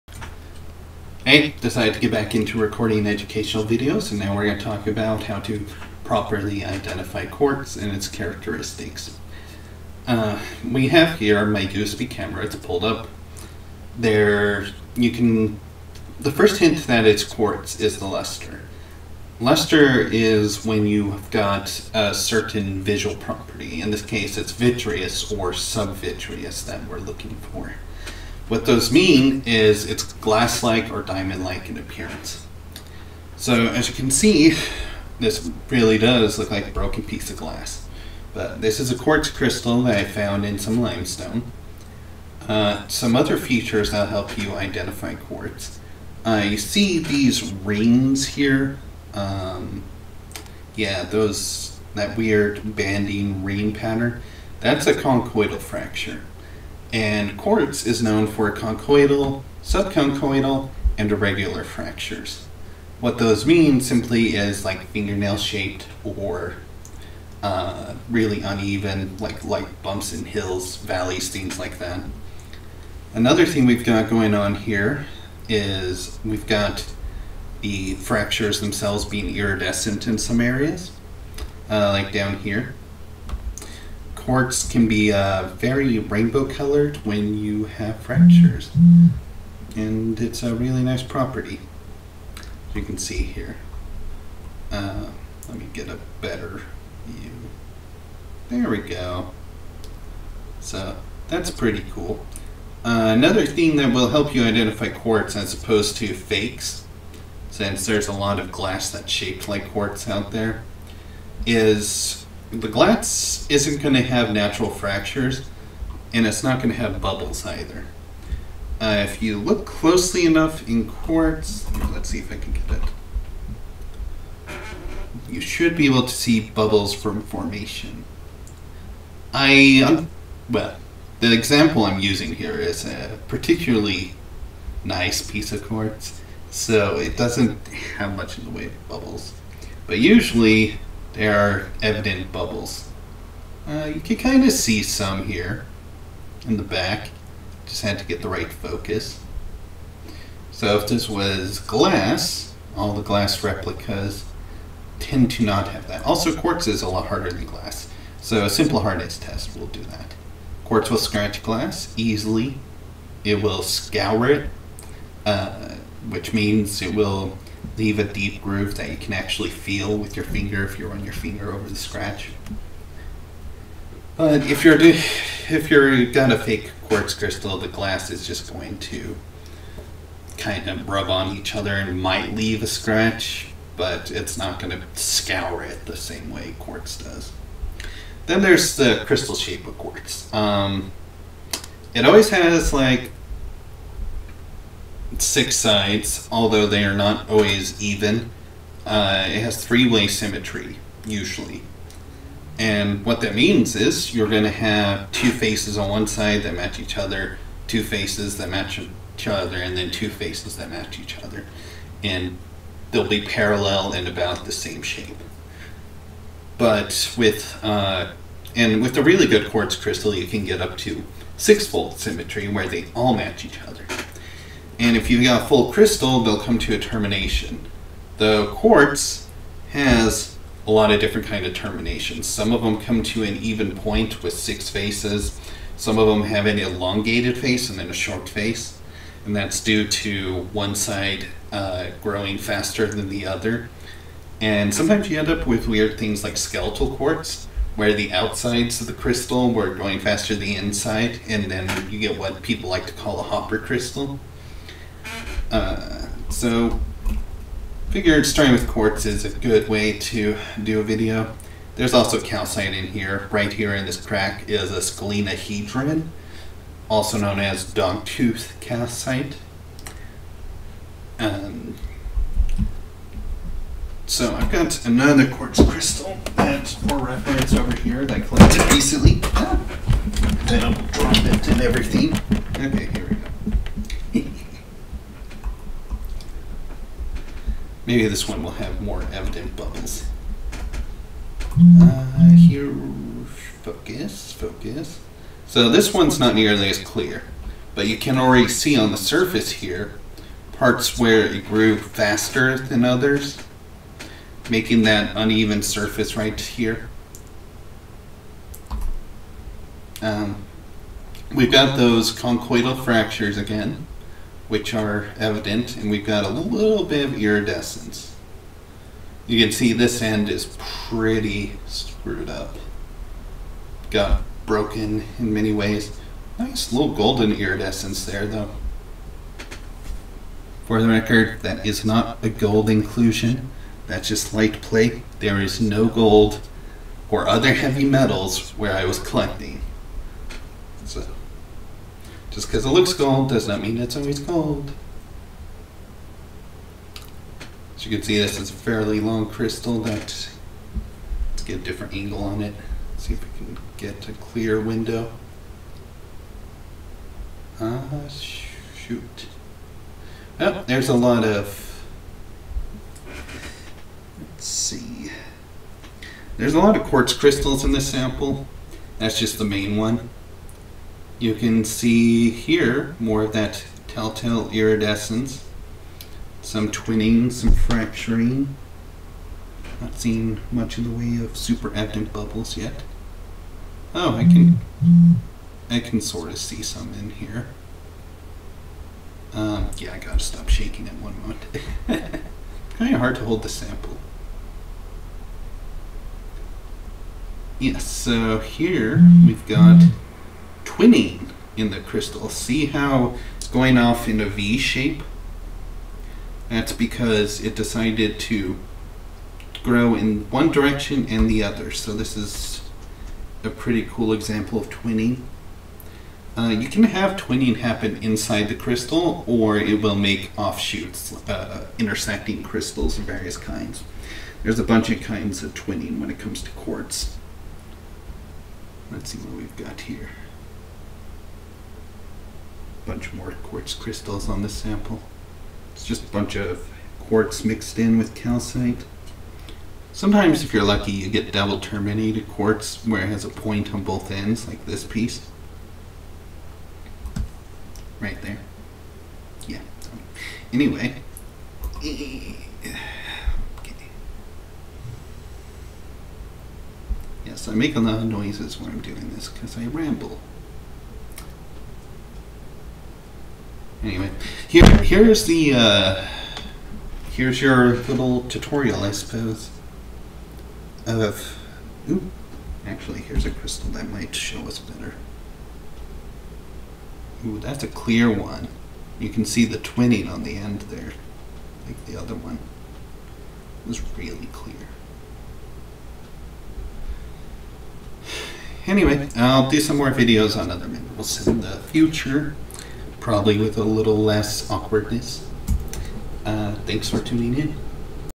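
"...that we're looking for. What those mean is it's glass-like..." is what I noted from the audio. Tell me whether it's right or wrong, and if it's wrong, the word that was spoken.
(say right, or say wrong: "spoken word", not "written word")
right.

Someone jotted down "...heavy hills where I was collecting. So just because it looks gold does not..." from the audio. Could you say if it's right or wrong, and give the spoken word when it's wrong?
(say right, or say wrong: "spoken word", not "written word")
wrong: "metals", not "hills".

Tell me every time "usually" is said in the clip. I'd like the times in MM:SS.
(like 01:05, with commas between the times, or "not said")
02:19, 03:21.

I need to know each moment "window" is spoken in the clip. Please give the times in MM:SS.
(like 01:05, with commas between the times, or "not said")
05:54.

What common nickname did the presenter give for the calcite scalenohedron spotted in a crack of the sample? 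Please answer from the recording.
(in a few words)
dogtooth calcite.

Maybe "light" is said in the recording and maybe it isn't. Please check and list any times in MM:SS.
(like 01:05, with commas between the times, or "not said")
01:09, 05:34.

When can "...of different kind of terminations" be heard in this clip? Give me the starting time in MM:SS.
03:50.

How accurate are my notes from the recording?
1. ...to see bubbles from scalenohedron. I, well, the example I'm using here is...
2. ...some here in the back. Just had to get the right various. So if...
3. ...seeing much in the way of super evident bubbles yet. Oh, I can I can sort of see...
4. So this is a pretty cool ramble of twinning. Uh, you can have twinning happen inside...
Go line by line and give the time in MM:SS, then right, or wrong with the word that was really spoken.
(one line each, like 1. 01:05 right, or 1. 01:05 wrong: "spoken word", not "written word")
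1. 02:06 wrong: "formation", not "scalenohedron"
2. 02:24 wrong: "focus", not "various"
3. 06:19 right
4. 06:51 wrong: "example", not "ramble".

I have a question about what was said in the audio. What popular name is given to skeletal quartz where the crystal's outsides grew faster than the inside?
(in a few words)
hopper crystal.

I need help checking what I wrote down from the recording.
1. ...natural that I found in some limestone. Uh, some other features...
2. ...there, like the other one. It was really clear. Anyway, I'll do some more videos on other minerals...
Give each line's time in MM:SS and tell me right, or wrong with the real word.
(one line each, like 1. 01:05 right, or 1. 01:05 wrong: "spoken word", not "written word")
1. 00:39 wrong: "crystal", not "natural"
2. 08:00 right.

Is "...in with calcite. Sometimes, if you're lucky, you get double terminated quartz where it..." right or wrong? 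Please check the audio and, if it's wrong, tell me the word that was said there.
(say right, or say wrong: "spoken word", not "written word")
right.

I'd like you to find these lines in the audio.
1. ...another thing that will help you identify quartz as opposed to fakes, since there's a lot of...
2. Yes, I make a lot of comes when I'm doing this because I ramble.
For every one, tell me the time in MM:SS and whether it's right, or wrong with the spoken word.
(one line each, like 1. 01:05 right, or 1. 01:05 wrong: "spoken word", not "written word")
1. 01:43 right
2. 07:37 wrong: "noises", not "comes".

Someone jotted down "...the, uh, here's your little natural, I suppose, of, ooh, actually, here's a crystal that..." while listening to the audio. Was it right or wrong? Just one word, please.
wrong.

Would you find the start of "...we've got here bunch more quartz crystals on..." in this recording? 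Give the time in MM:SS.
07:09.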